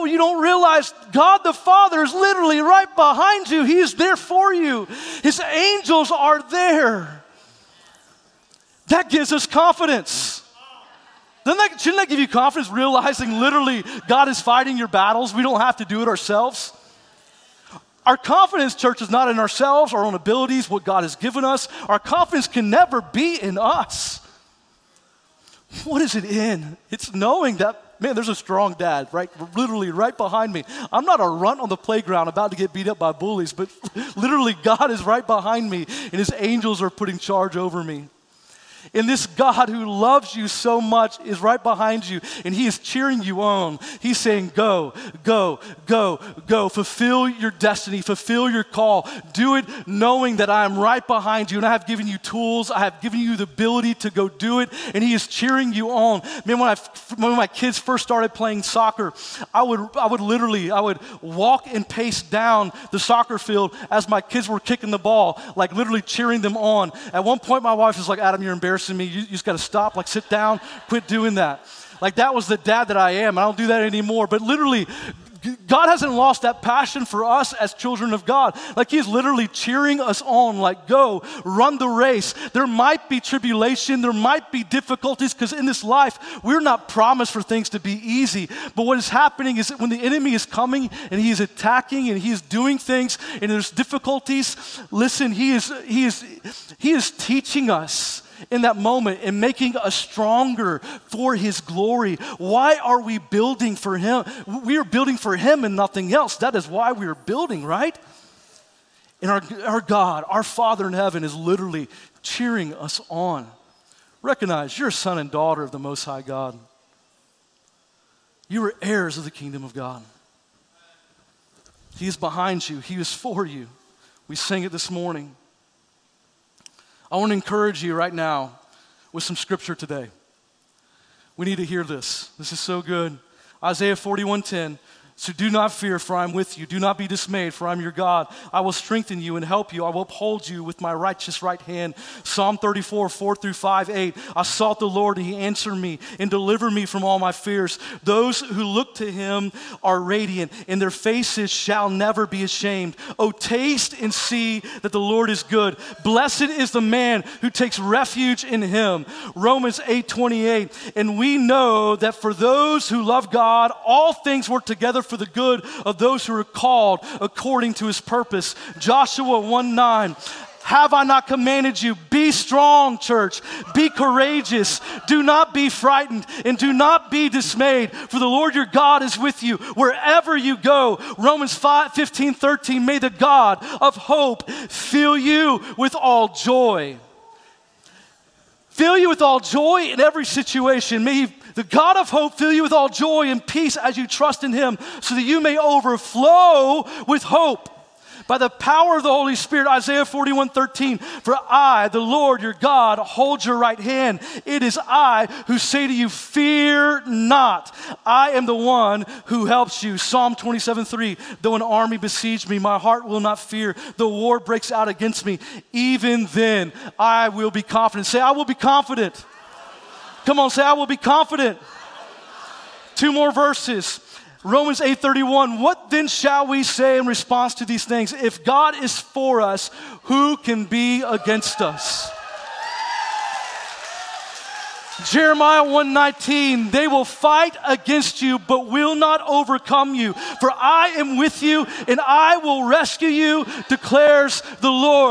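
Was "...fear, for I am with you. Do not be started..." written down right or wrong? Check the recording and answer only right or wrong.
wrong.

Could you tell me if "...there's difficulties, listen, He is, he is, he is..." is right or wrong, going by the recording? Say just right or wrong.
right.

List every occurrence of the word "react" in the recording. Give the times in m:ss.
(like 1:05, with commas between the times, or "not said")
not said.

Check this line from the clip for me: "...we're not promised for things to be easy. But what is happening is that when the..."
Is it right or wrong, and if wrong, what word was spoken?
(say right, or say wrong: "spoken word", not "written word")
right.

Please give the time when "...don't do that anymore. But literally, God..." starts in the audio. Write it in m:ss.
1:13.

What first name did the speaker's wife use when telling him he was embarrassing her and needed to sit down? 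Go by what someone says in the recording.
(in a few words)
Adam.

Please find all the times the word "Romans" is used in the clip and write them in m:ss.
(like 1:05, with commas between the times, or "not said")
2:39, 3:01, 3:44.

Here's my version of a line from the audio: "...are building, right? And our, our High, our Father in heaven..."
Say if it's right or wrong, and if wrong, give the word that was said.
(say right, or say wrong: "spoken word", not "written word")
wrong: "God", not "High".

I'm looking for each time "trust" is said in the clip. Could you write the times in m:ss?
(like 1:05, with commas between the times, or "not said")
3:14.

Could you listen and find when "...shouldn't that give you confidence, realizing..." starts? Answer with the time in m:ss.
0:11.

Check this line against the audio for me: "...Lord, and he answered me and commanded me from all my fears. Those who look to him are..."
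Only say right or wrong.
wrong.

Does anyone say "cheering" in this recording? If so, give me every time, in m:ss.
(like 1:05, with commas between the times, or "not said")
0:42, 0:55, 1:06, 1:19, 1:52.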